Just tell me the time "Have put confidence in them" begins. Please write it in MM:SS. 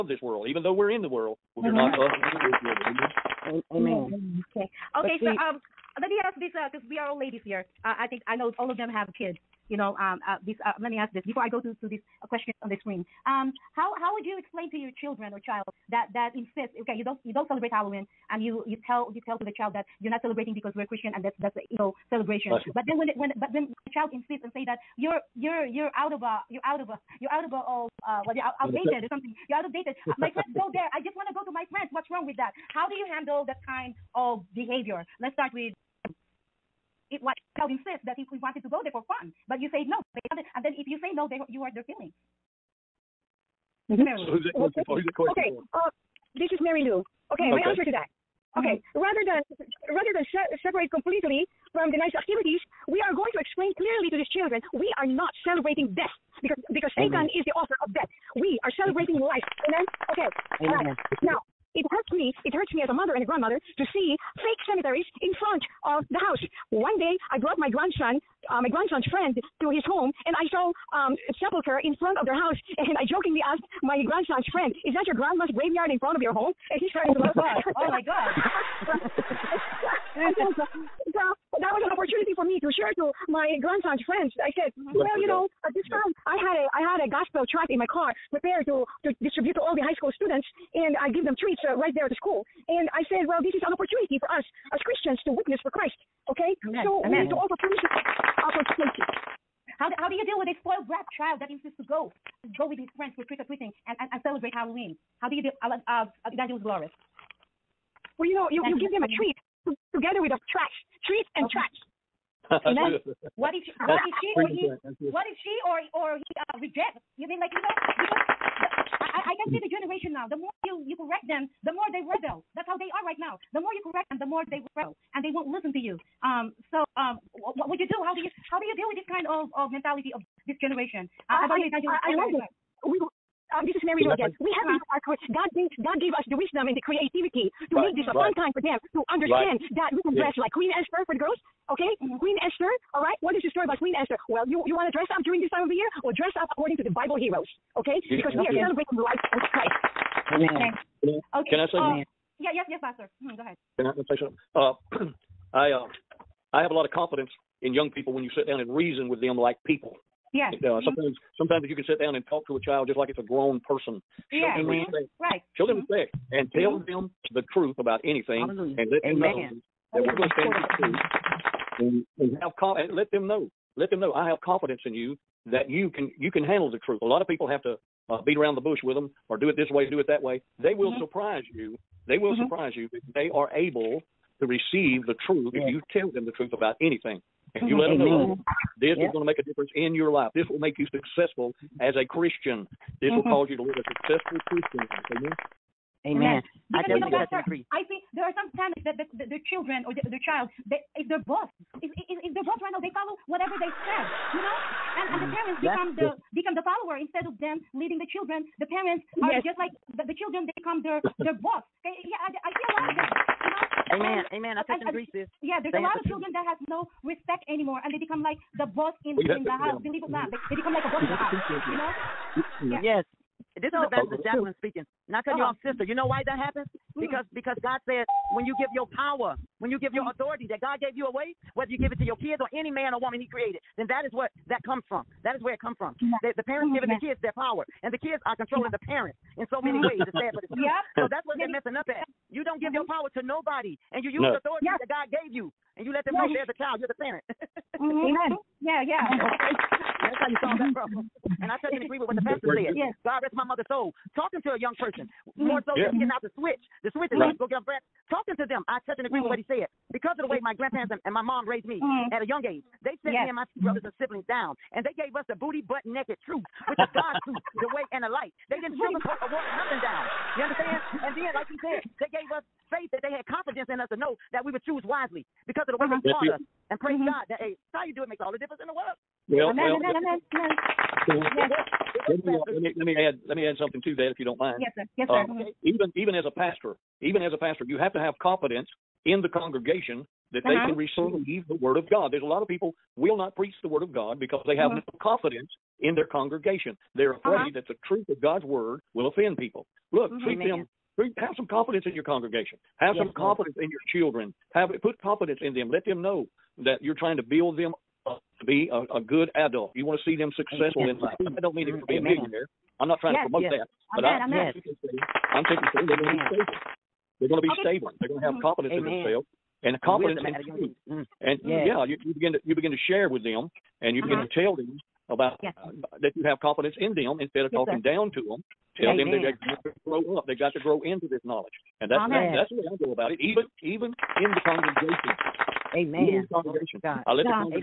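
05:04.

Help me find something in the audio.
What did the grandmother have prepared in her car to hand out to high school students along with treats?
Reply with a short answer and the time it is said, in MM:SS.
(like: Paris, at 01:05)
a gospel tract, at 01:27.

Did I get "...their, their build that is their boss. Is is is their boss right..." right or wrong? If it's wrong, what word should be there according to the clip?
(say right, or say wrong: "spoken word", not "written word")
wrong: "child", not "build".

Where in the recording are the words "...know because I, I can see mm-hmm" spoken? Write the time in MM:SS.
01:57.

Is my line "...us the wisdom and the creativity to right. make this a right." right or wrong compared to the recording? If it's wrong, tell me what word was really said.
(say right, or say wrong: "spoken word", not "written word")
right.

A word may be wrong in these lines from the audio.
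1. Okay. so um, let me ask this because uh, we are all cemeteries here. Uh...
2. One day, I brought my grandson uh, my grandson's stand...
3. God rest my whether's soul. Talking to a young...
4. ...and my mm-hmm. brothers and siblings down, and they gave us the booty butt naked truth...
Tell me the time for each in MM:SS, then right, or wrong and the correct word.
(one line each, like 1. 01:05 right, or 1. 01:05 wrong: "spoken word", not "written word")
1. 00:04 wrong: "ladies", not "cemeteries"
2. 01:06 wrong: "friend", not "stand"
3. 04:13 wrong: "mother", not "whether"
4. 04:23 right.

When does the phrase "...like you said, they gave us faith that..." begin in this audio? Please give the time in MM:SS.
04:31.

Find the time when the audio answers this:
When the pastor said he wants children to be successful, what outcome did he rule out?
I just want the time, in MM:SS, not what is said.
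05:12.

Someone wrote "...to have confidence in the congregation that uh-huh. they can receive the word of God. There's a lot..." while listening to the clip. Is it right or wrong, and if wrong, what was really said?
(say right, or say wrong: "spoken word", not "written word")
right.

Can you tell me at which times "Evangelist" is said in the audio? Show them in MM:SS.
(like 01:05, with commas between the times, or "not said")
01:46, 03:43.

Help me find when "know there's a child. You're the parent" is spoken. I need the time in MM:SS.
04:06.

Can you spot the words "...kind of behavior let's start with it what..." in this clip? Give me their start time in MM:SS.
00:33.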